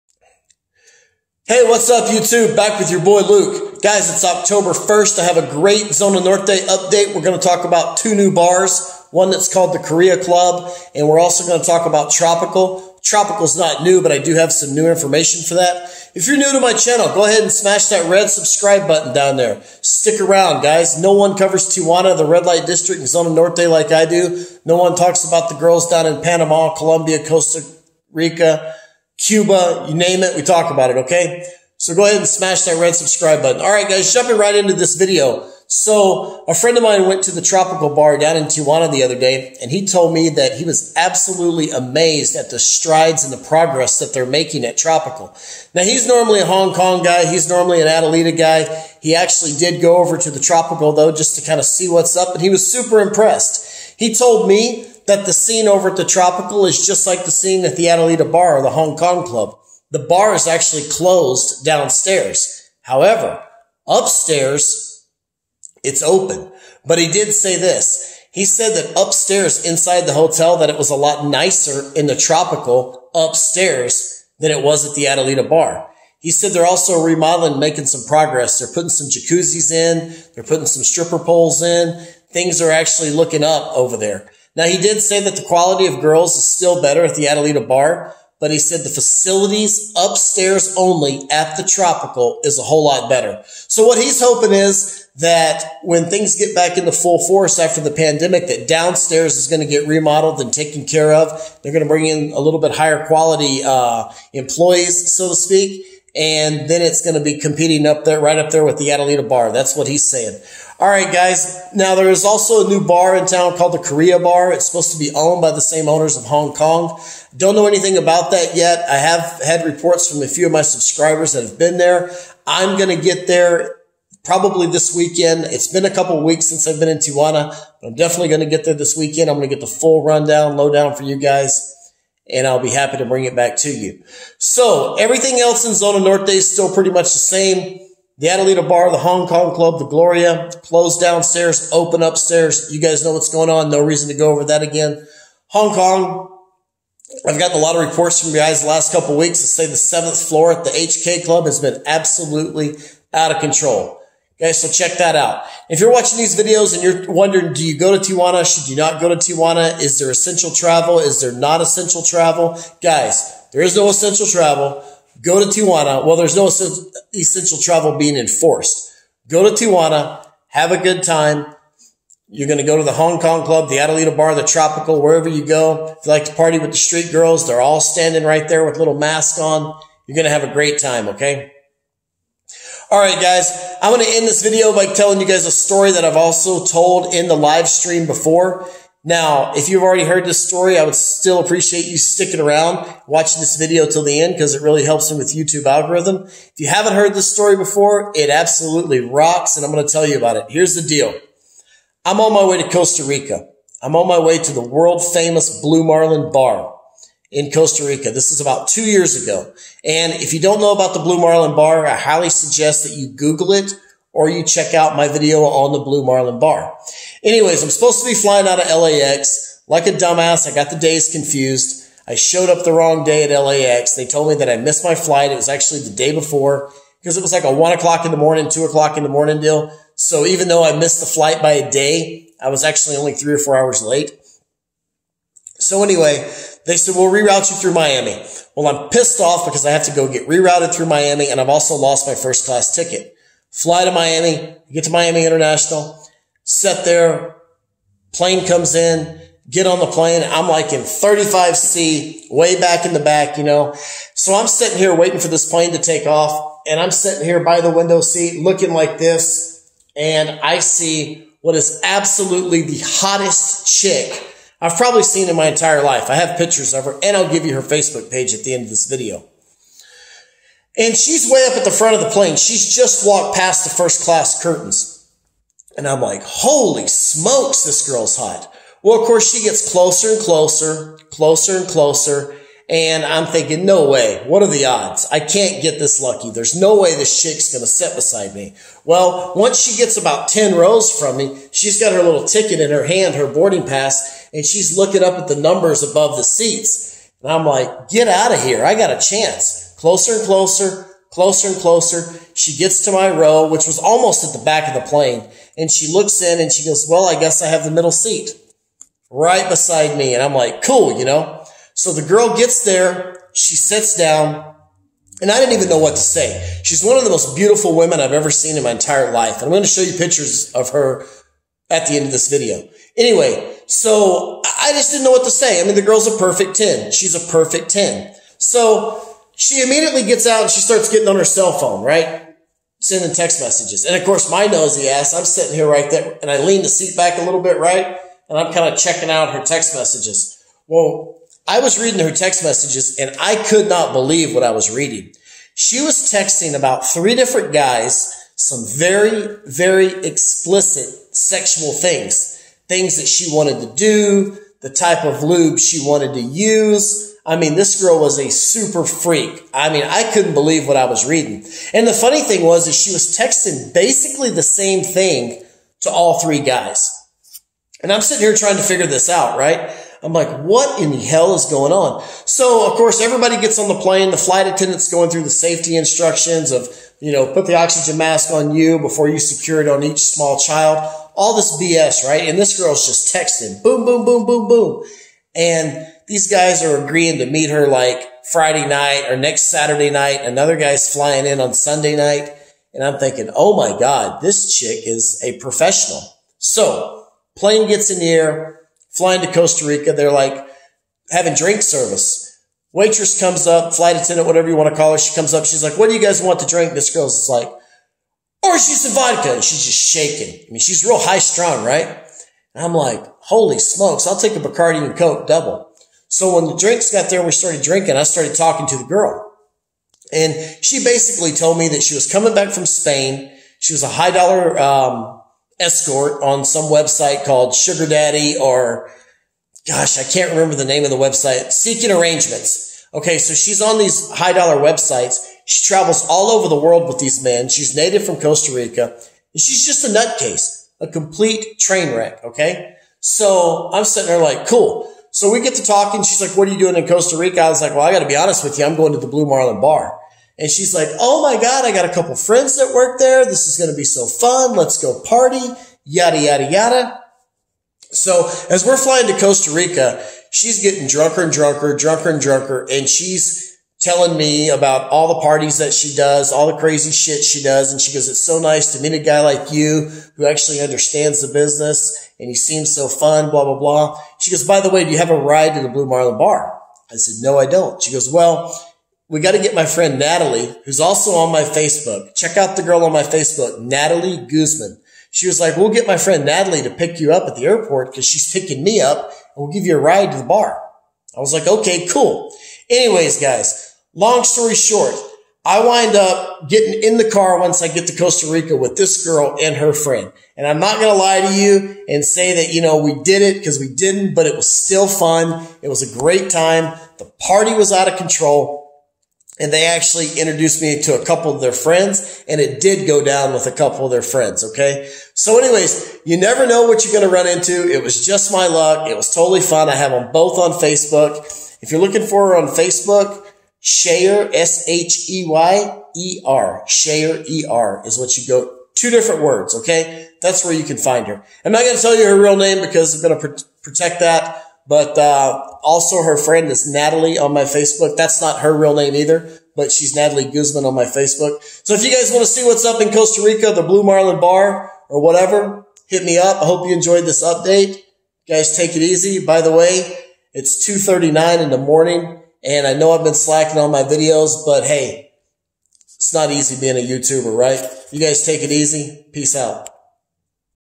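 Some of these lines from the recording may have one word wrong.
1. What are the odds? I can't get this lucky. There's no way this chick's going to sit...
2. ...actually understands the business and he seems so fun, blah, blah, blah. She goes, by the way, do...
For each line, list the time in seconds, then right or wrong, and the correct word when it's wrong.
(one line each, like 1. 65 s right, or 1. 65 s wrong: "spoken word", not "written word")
1. 284 s right
2. 470 s right.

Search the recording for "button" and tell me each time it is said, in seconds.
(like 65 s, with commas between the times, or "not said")
18 s, 33 s.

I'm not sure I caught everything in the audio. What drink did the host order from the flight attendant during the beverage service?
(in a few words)
Bacardi and Coke double.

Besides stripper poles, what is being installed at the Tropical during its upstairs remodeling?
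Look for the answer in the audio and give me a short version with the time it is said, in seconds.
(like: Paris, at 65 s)
jacuzzis, at 79 s.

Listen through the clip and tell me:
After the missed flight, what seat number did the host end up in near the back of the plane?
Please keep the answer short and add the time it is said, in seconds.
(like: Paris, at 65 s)
35C, at 250 s.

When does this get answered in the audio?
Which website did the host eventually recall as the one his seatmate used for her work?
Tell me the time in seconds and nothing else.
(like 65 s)
431 s.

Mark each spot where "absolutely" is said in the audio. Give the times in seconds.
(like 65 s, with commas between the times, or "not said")
40 s, 151 s, 198 s, 261 s.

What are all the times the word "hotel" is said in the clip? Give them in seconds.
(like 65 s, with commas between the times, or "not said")
70 s.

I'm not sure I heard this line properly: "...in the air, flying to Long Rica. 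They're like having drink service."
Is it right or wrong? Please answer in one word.
wrong.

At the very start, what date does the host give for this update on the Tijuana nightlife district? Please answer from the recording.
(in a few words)
October 1st.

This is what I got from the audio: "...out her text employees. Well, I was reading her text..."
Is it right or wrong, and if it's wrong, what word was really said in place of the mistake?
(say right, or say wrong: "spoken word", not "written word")
wrong: "messages", not "employees".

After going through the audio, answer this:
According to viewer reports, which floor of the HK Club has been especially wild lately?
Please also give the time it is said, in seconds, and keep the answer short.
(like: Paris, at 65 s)
seventh floor, at 149 s.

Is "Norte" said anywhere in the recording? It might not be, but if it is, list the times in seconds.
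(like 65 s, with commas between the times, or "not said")
6 s, 23 s, 136 s.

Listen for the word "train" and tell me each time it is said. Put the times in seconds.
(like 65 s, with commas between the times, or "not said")
441 s.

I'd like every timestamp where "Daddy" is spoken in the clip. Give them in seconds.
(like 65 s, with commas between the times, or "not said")
427 s.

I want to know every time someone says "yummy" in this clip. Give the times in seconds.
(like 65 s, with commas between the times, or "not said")
not said.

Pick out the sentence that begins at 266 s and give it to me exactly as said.
I have pictures of her, and I'll give you her Facebook page at the end of this video.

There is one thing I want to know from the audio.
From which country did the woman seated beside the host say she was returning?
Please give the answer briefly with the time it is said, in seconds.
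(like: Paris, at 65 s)
Spain, at 422 s.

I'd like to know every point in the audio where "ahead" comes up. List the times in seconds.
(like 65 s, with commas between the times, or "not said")
17 s, 32 s.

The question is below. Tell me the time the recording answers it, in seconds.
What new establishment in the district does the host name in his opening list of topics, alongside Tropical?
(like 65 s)
9 s.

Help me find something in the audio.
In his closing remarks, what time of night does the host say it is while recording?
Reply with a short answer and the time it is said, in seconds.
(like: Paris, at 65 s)
2:39, at 550 s.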